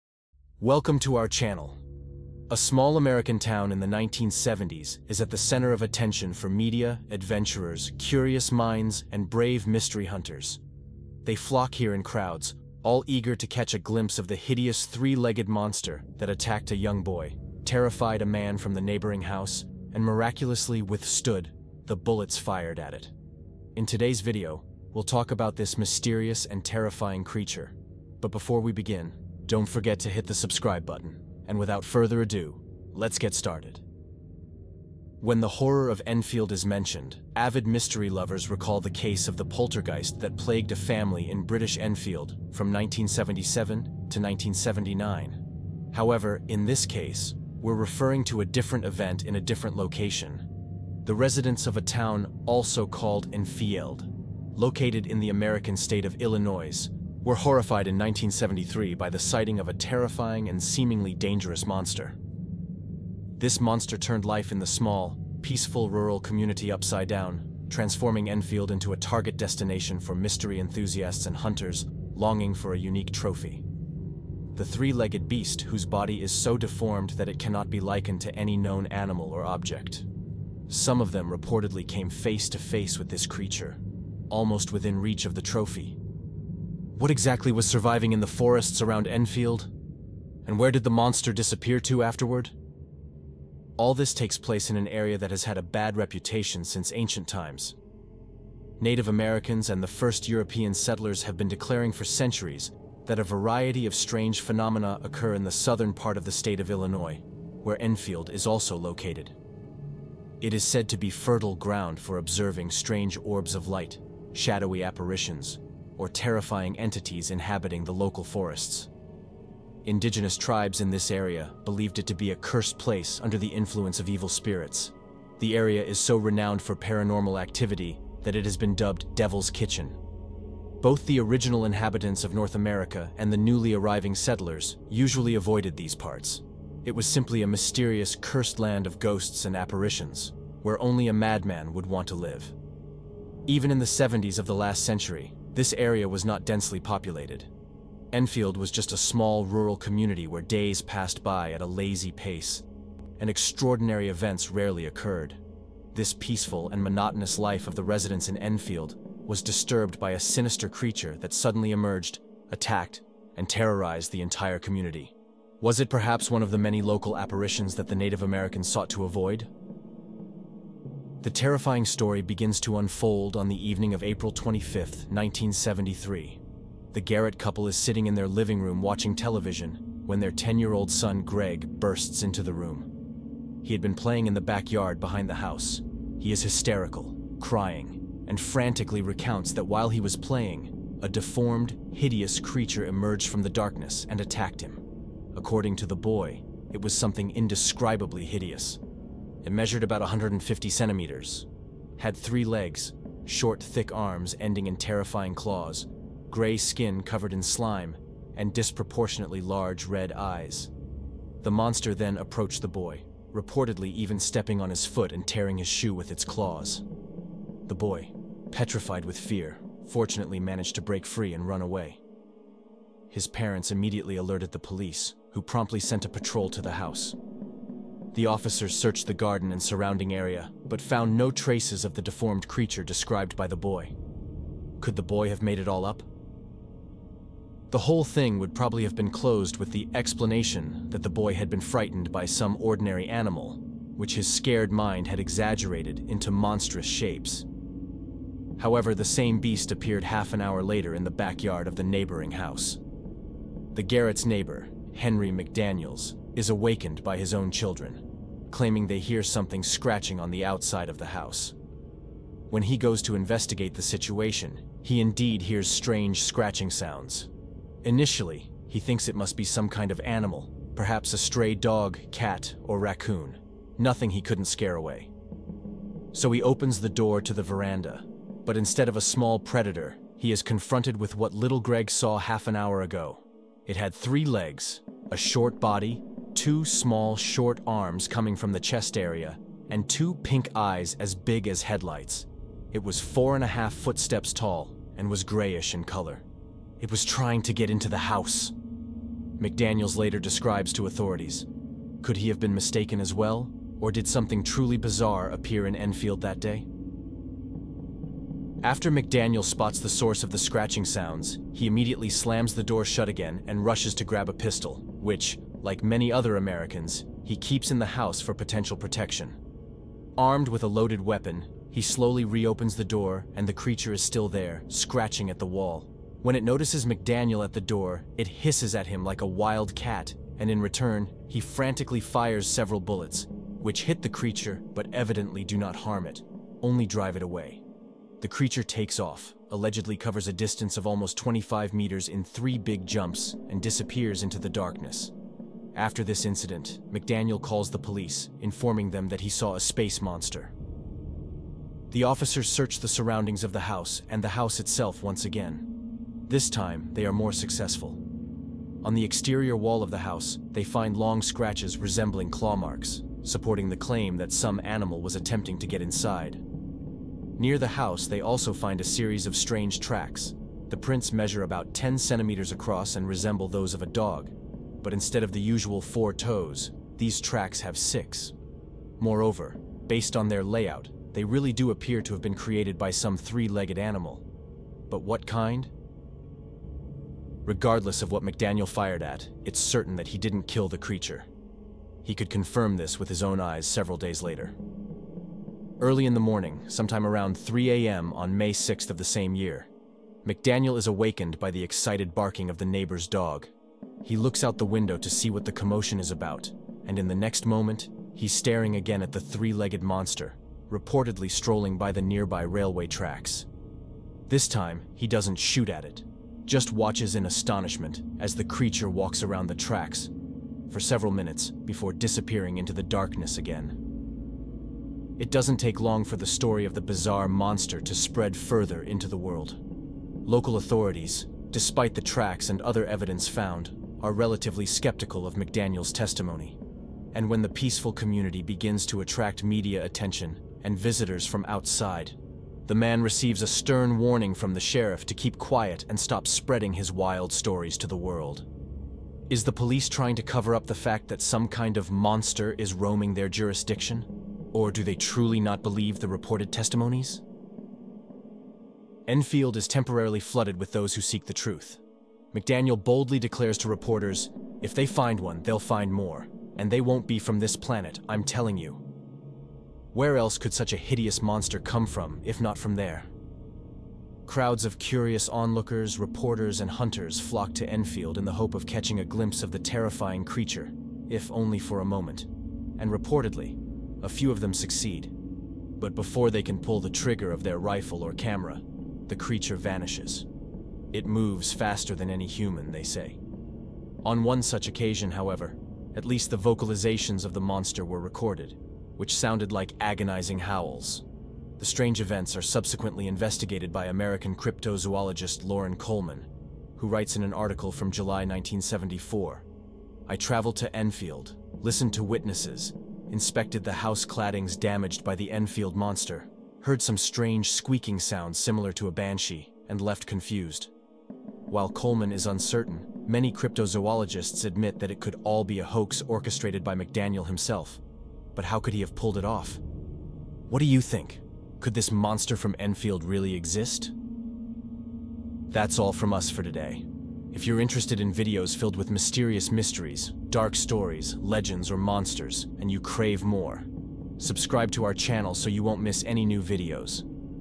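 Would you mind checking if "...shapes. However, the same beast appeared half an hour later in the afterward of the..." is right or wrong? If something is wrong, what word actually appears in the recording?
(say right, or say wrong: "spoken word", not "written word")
wrong: "backyard", not "afterward".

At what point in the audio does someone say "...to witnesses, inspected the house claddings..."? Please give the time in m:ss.
8:31.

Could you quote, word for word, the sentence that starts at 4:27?
Initially, he thinks it must be some kind of animal, perhaps a stray dog, cat, or raccoon.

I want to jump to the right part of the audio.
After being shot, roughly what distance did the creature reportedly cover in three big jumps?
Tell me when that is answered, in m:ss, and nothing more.
5:41.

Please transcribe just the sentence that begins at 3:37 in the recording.
The boy, petrified with fear, fortunately managed to break free and run away.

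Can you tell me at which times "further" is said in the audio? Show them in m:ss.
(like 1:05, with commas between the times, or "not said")
0:31, 7:08.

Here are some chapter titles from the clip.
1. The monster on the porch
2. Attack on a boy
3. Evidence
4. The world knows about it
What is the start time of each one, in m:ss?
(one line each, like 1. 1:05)
1. 3:57
2. 2:50
3. 5:45
4. 7:04.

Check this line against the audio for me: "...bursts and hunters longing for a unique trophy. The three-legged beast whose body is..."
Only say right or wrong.
wrong.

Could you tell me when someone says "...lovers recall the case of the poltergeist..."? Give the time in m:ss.
0:38.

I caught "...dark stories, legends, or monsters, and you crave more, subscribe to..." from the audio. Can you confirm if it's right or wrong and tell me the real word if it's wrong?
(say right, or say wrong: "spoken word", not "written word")
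right.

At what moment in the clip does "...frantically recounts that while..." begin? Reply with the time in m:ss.
3:08.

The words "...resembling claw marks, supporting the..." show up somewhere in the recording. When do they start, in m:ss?
6:01.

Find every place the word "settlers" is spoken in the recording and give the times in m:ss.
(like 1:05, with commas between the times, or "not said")
1:40, 2:14.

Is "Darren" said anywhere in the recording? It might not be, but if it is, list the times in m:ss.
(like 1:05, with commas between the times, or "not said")
not said.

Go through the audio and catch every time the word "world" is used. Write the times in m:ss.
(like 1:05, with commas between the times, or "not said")
7:09, 7:27.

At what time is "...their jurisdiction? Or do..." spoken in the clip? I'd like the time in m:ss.
7:33.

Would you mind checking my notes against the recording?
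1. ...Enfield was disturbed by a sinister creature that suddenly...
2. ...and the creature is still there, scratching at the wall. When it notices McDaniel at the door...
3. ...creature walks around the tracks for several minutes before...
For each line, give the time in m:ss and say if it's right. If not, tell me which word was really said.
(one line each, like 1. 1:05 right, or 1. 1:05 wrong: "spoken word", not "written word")
1. 2:38 right
2. 5:23 right
3. 6:58 right.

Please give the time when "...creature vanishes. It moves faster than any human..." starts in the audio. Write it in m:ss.
8:09.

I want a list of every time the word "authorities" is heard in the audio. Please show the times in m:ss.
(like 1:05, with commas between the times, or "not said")
5:00, 7:10.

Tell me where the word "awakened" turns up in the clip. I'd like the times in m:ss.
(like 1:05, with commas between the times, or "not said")
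4:16, 6:40.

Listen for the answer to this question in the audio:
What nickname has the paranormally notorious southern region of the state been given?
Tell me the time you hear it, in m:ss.
2:09.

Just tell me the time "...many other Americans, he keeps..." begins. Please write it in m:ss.
5:15.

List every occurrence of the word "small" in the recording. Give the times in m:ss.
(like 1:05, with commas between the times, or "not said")
0:02, 1:04, 2:28, 4:39, 4:46.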